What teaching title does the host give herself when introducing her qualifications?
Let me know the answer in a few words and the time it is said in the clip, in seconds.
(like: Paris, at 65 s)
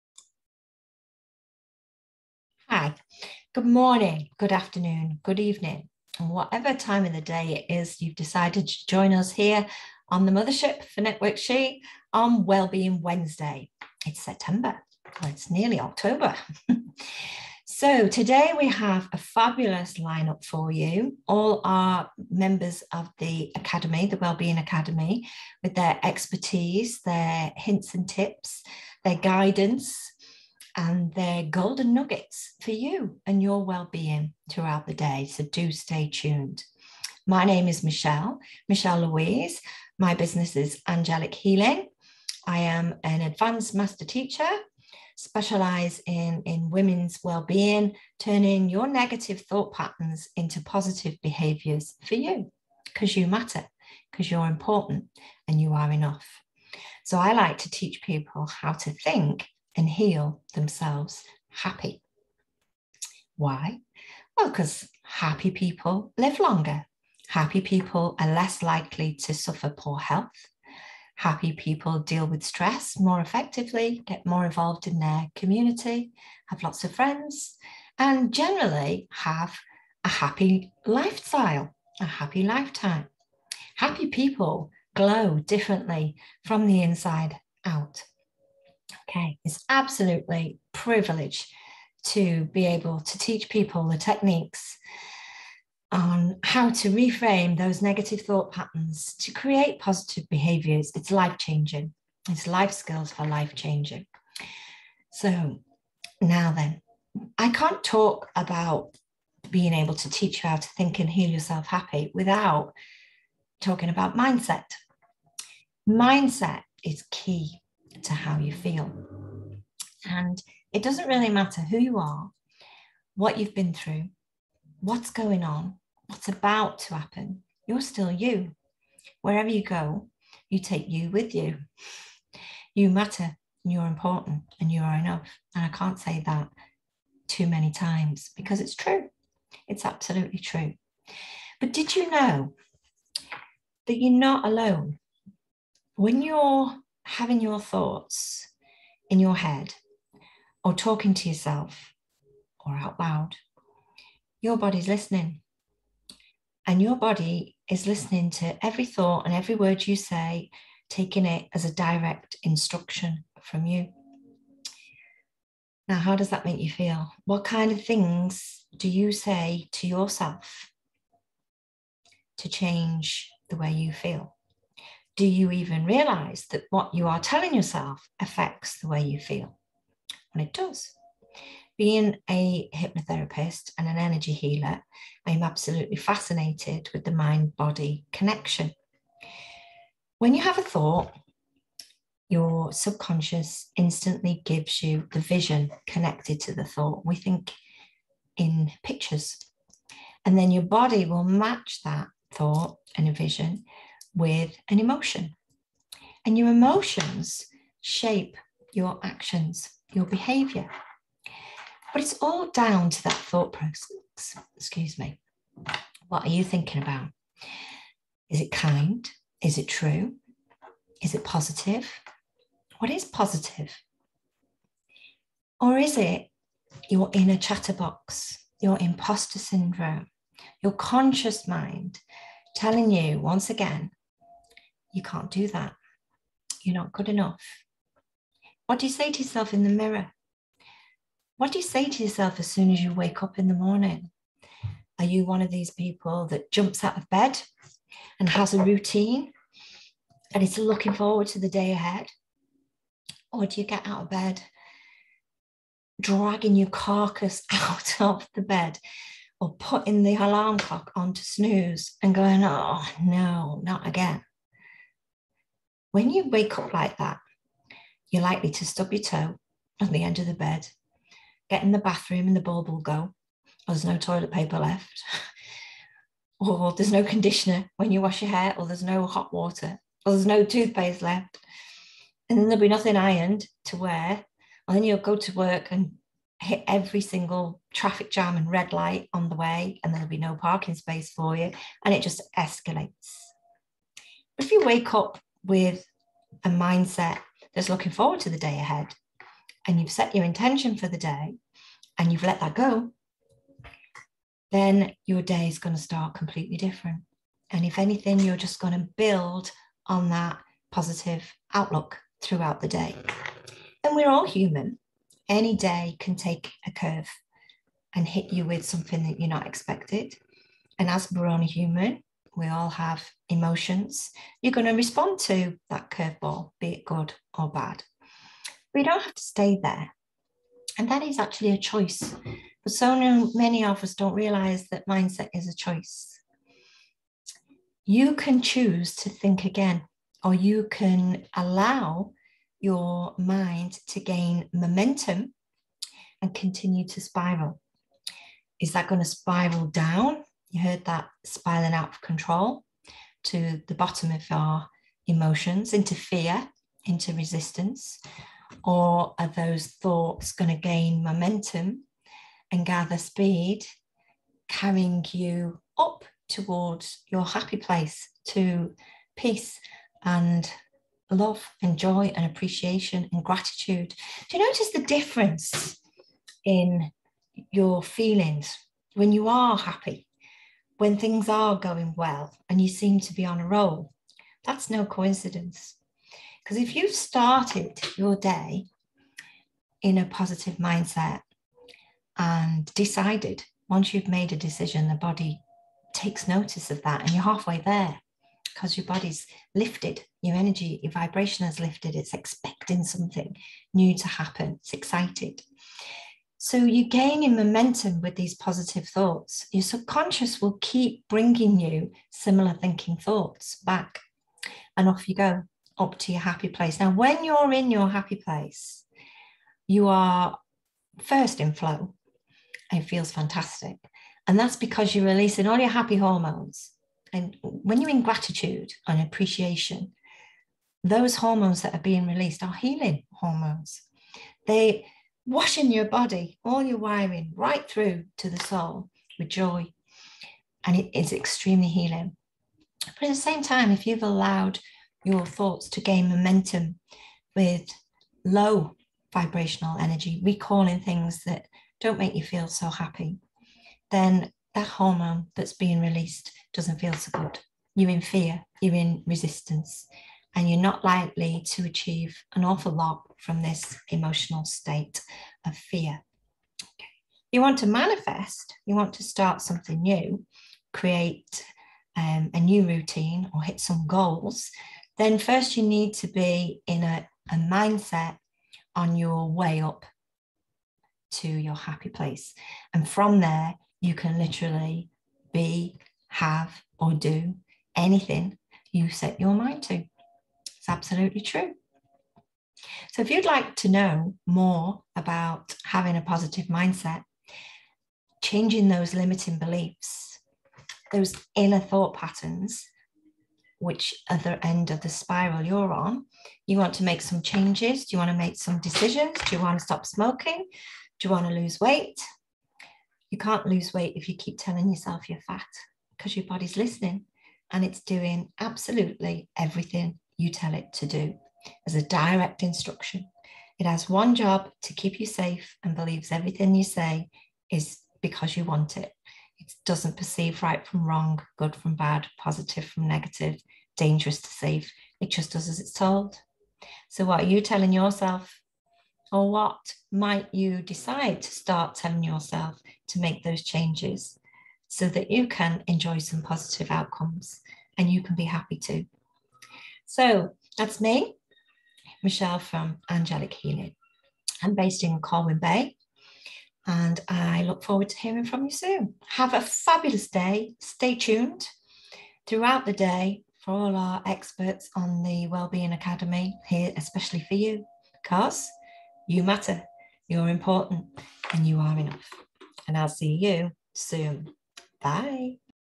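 advanced master teacher, at 43 s.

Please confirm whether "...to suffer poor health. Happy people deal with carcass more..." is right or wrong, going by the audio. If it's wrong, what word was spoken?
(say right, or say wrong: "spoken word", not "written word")
wrong: "stress", not "carcass".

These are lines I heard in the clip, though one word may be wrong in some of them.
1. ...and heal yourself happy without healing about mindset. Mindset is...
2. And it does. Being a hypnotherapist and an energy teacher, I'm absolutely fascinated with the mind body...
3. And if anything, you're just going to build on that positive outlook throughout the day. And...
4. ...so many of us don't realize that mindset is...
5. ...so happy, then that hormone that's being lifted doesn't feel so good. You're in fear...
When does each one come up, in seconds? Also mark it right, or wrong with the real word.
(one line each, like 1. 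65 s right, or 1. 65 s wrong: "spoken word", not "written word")
1. 110 s wrong: "talking", not "healing"
2. 180 s wrong: "healer", not "teacher"
3. 307 s right
4. 332 s right
5. 452 s wrong: "released", not "lifted".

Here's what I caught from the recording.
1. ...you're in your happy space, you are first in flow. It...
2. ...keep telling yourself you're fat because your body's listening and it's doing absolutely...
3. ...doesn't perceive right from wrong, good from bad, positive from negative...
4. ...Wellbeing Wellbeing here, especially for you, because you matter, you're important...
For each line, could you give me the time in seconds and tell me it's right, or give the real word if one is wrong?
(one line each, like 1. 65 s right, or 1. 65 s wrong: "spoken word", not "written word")
1. 417 s wrong: "place", not "space"
2. 514 s right
3. 529 s right
4. 565 s wrong: "Academy", not "Wellbeing".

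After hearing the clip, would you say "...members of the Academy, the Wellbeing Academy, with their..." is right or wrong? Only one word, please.
right.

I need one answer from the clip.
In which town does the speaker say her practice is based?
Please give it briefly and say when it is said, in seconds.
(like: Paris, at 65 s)
Colwyn Bay, at 555 s.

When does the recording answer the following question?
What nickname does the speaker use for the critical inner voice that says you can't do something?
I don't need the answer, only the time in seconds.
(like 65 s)
227 s.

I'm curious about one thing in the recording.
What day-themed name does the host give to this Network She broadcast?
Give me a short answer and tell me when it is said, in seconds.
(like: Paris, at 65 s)
Wellbeing Wednesday, at 12 s.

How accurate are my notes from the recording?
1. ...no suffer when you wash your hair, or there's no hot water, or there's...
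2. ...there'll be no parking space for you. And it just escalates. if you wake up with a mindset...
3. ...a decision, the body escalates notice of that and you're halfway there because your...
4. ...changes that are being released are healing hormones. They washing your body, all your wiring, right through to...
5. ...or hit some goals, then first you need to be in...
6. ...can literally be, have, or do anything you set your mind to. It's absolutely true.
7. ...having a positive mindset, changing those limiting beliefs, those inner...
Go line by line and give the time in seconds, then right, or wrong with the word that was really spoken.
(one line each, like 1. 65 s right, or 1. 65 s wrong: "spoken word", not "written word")
1. 276 s wrong: "conditioner", not "suffer"
2. 289 s right
3. 394 s wrong: "takes", not "escalates"
4. 431 s wrong: "hormones", not "changes"
5. 473 s right
6. 483 s right
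7. 495 s right.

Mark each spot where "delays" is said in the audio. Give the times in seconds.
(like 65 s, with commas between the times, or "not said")
not said.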